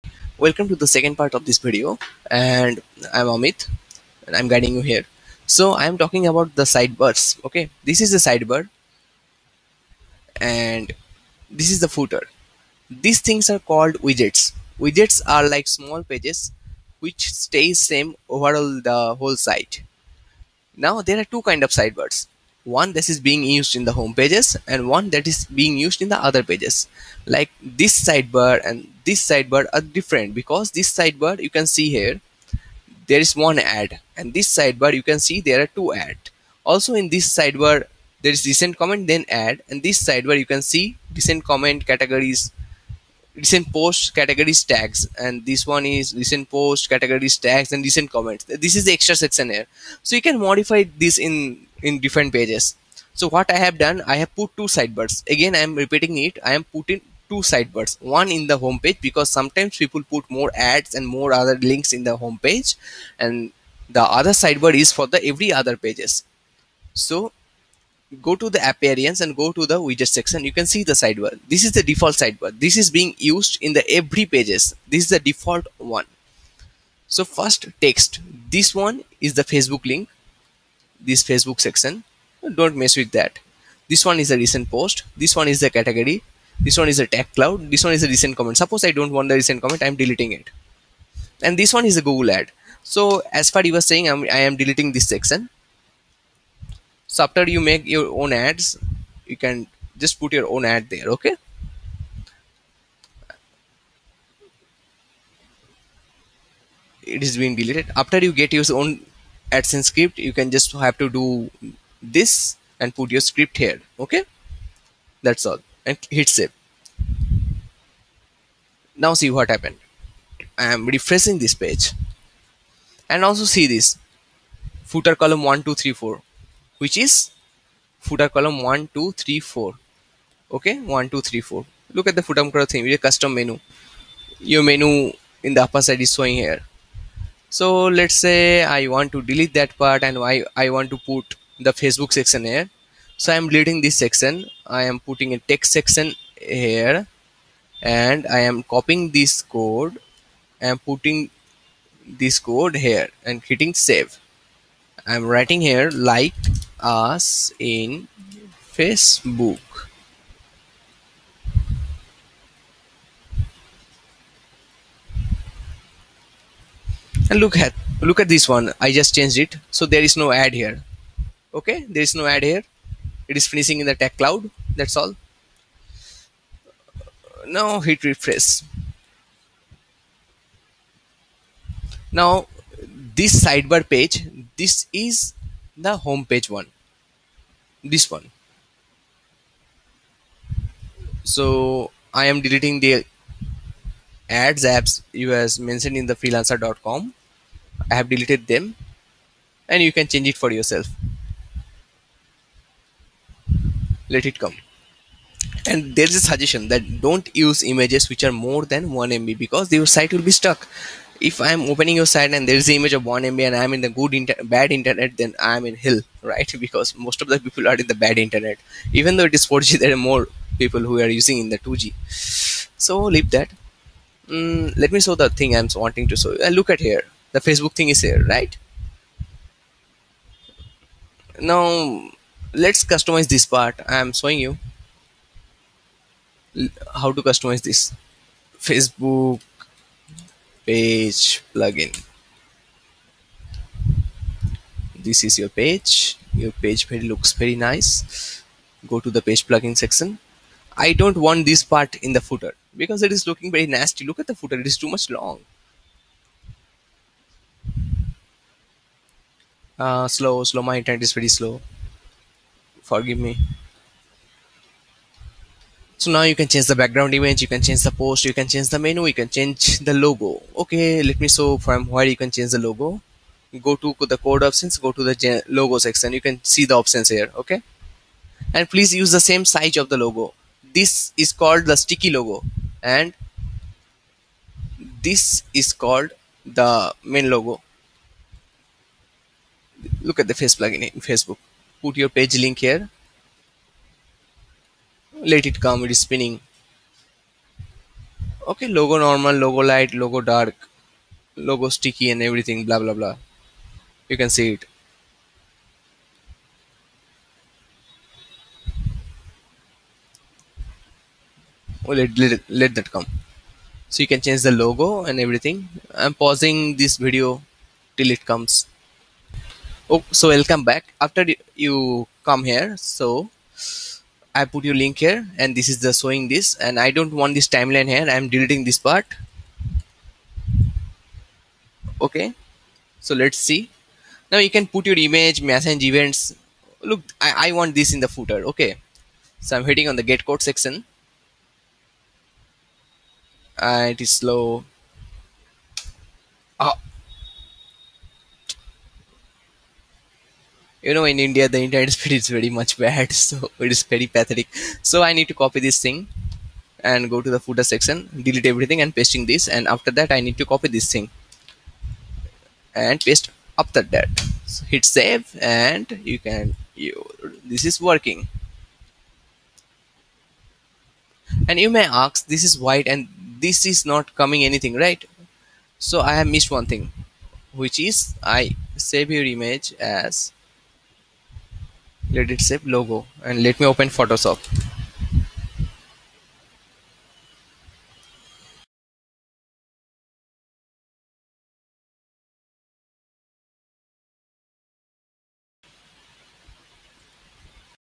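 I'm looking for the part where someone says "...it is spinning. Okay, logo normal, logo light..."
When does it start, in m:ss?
4:55.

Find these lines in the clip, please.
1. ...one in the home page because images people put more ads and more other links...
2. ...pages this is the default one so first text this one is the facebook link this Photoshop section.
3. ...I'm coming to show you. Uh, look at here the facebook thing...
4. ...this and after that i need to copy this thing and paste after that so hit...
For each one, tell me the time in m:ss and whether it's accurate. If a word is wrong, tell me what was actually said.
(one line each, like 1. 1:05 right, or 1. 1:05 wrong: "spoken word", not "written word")
1. 0:58 wrong: "sometimes", not "images"
2. 1:14 wrong: "Facebook", not "Photoshop"
3. 3:45 wrong: "wanting", not "coming"
4. 5:59 right.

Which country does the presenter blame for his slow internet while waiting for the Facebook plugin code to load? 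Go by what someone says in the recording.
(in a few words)
India.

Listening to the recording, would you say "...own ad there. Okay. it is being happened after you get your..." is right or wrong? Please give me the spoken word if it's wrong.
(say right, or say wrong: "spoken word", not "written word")
wrong: "deleted", not "happened".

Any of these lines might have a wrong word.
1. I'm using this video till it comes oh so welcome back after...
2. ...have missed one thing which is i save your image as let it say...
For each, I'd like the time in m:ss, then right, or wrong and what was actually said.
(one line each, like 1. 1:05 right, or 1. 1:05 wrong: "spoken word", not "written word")
1. 5:15 wrong: "pausing", not "using"
2. 6:16 right.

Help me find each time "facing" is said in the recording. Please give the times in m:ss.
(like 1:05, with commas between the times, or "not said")
not said.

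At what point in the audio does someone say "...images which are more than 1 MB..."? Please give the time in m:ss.
3:27.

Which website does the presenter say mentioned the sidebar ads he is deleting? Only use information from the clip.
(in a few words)
freelancer.com.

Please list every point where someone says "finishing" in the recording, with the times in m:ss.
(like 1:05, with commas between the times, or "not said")
2:53.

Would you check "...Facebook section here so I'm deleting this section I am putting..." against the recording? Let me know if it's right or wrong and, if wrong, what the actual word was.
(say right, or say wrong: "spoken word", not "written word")
right.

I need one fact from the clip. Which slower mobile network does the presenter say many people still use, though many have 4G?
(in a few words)
2G.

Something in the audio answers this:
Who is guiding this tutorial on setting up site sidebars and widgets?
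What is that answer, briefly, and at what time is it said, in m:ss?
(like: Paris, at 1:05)
Amit, at 0:03.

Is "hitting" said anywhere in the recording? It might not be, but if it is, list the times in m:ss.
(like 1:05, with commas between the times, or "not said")
2:33, 5:39.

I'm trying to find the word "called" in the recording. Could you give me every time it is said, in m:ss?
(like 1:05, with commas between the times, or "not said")
0:13, 4:41, 4:45.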